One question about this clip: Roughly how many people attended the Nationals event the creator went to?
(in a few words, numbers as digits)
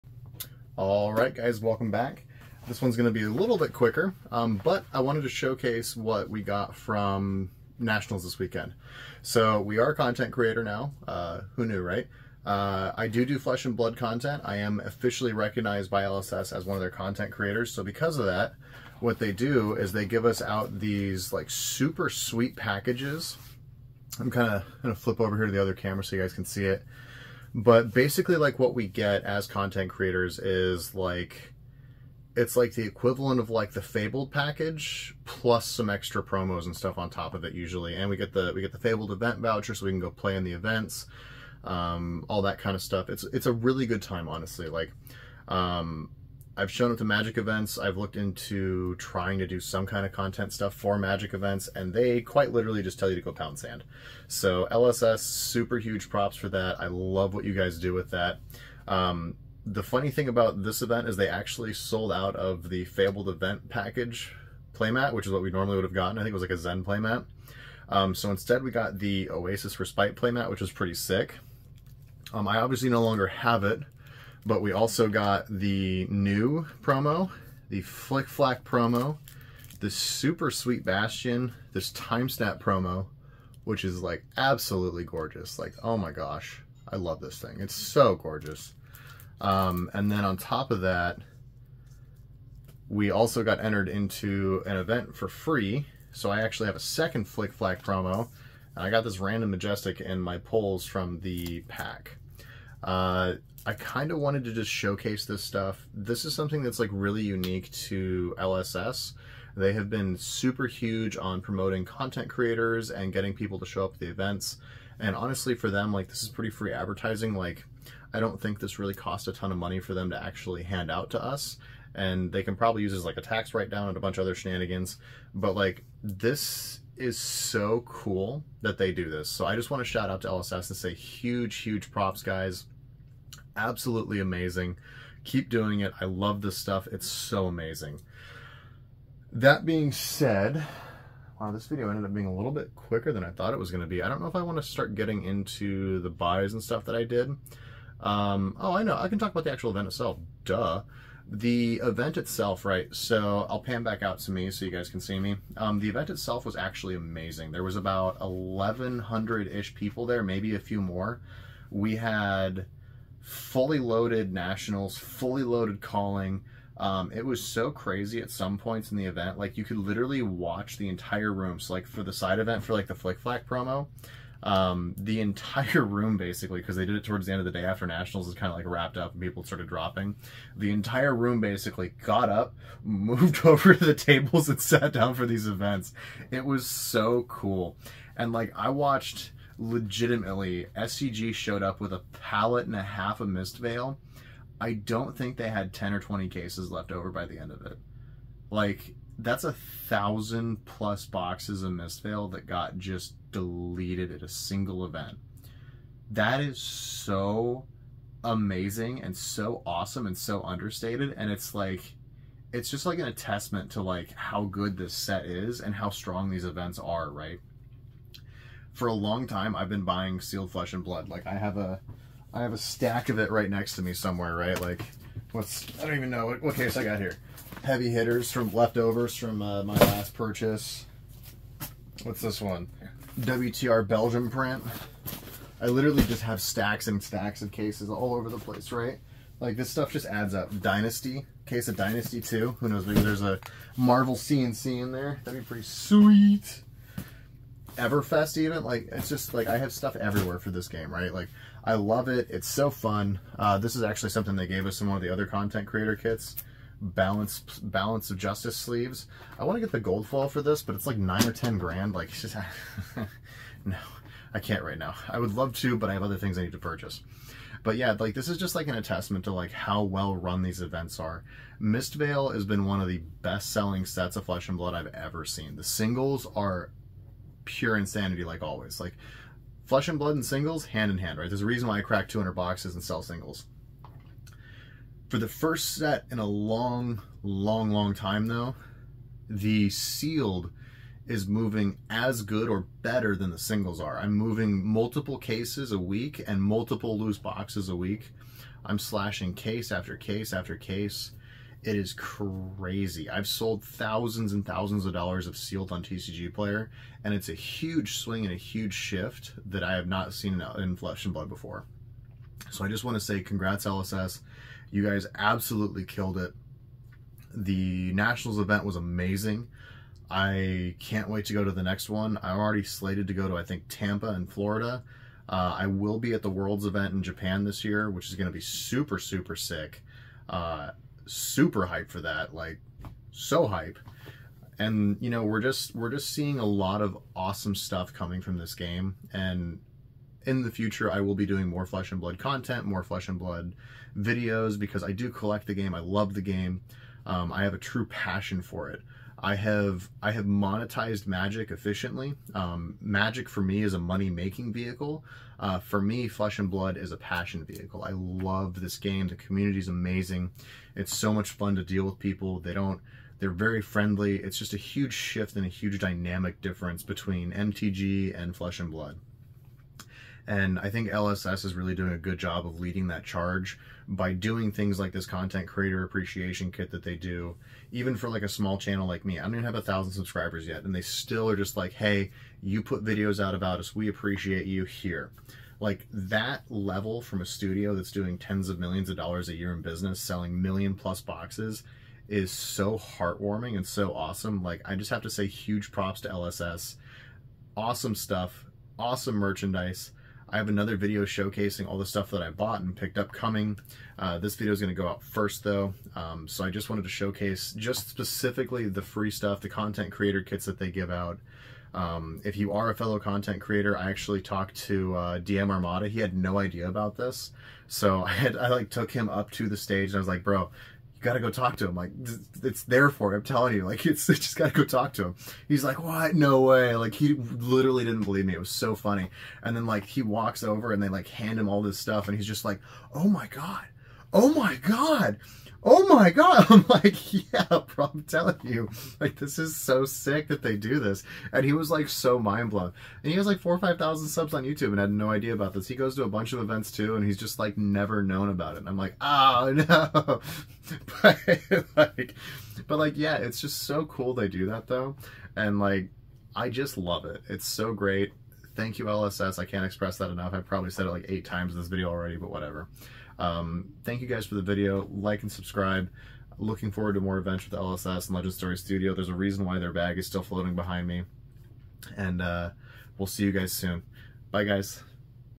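1,100.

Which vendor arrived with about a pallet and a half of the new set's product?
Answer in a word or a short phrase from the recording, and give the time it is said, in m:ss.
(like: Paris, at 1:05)
SCG, at 3:10.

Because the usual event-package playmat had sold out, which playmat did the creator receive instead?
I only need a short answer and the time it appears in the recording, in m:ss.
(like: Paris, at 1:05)
Oasis Respite, at 1:09.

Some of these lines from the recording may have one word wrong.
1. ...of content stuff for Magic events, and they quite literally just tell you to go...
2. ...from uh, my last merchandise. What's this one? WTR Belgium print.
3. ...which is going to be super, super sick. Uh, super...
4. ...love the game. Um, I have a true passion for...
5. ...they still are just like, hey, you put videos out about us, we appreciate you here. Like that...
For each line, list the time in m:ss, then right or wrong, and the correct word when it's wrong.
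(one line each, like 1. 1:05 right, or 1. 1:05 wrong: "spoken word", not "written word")
1. 0:50 right
2. 3:49 wrong: "purchase", not "merchandise"
3. 5:27 right
4. 5:45 right
5. 6:20 right.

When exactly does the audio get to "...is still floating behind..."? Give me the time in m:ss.
7:49.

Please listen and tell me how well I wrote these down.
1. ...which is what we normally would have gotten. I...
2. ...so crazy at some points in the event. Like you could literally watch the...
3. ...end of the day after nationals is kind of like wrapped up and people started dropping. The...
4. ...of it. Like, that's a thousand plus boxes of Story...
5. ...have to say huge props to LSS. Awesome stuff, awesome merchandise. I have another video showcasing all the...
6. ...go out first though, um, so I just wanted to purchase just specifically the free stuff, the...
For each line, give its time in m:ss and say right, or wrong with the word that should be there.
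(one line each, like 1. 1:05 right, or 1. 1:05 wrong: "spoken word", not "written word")
1. 1:05 right
2. 2:47 right
3. 2:57 right
4. 3:17 wrong: "Mistveil", not "Story"
5. 6:34 right
6. 6:44 wrong: "showcase", not "purchase".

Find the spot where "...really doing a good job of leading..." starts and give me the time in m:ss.
6:11.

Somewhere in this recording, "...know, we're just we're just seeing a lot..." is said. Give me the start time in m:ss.
5:35.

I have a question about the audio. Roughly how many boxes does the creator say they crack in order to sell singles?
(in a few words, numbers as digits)
200.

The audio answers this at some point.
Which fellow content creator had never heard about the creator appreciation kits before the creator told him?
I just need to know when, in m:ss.
6:55.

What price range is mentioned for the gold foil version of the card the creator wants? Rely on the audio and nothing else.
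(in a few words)
9 or 10 grand.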